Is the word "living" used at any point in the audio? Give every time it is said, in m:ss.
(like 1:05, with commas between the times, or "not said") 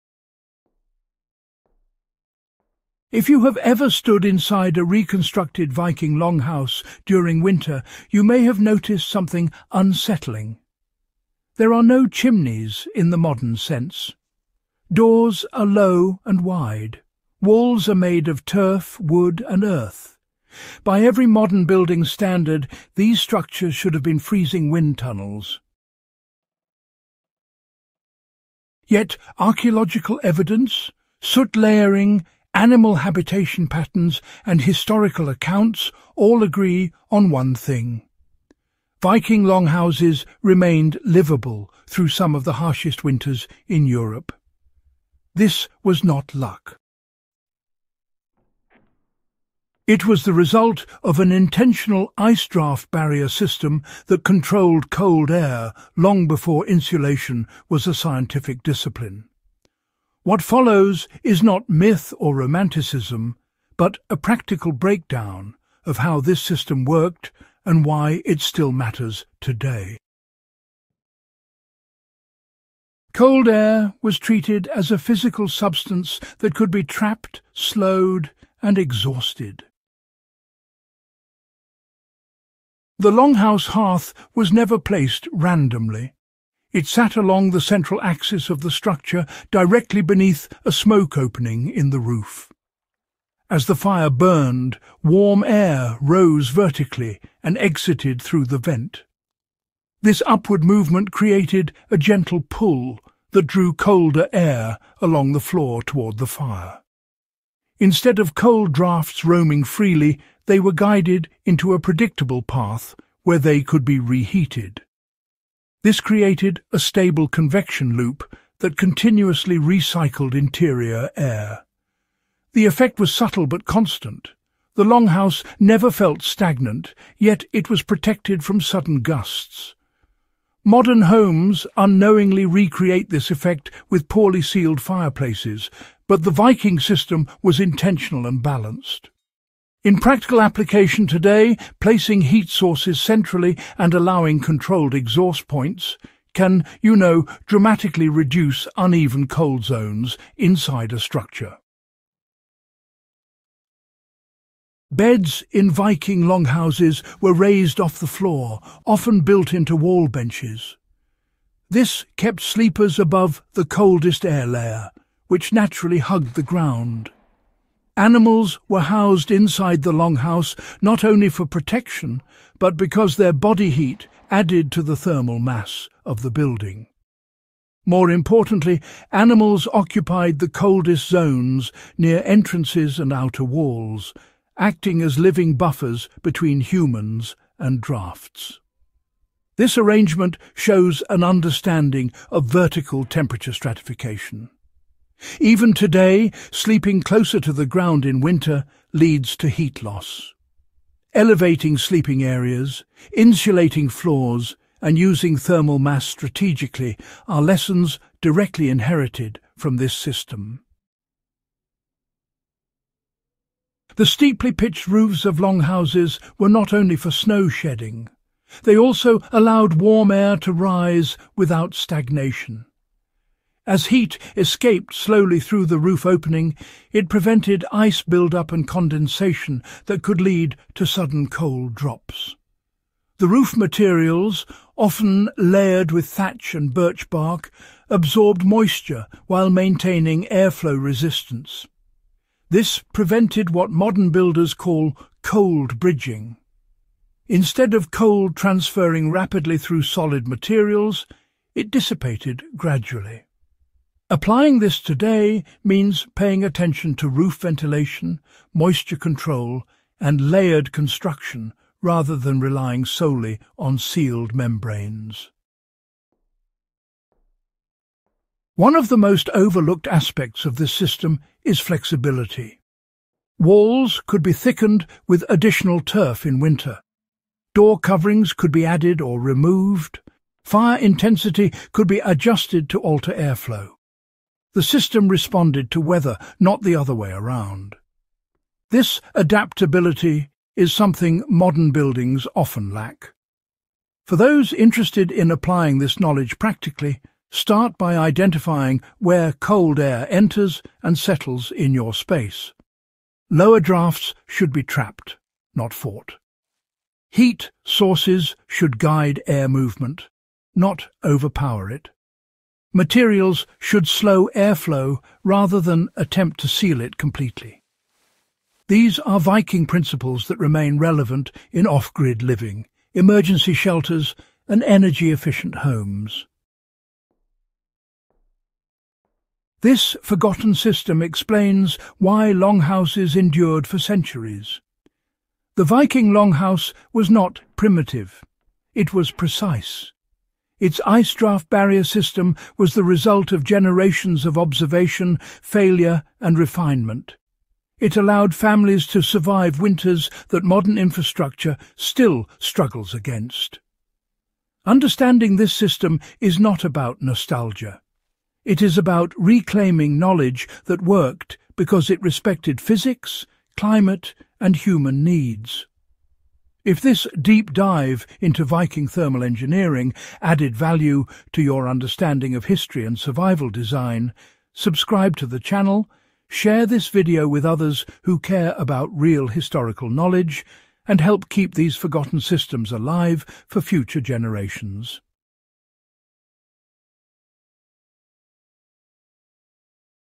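3:05, 5:22.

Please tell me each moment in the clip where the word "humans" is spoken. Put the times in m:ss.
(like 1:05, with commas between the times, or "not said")
3:06, 6:04.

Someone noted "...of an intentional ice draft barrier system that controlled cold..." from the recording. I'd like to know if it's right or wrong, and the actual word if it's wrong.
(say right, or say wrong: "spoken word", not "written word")
right.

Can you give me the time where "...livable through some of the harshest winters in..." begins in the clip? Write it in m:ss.
0:41.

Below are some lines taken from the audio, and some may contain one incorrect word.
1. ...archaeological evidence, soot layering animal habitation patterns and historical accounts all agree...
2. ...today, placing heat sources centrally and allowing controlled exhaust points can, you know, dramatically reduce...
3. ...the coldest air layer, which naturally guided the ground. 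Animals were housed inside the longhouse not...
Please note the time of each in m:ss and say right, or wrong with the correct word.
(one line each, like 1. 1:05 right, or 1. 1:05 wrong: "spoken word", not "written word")
1. 0:29 right
2. 2:21 right
3. 2:43 wrong: "hugged", not "guided".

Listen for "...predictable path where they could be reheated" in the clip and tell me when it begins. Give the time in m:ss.
1:51.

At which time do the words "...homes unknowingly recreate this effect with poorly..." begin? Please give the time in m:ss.
2:11.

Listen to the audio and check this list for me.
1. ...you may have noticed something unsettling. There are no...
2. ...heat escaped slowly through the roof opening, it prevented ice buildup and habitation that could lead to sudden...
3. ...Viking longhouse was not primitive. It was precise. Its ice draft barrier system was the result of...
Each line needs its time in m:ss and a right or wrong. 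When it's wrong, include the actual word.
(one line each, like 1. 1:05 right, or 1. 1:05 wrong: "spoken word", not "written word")
1. 0:08 right
2. 3:43 wrong: "condensation", not "habitation"
3. 5:35 right.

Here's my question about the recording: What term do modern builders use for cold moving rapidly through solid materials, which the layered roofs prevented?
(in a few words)
cold bridging.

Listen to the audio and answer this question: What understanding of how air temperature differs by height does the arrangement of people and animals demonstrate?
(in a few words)
vertical temperature stratification.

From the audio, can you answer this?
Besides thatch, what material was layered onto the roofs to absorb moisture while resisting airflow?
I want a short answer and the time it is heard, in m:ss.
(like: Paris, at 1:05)
birch bark, at 3:56.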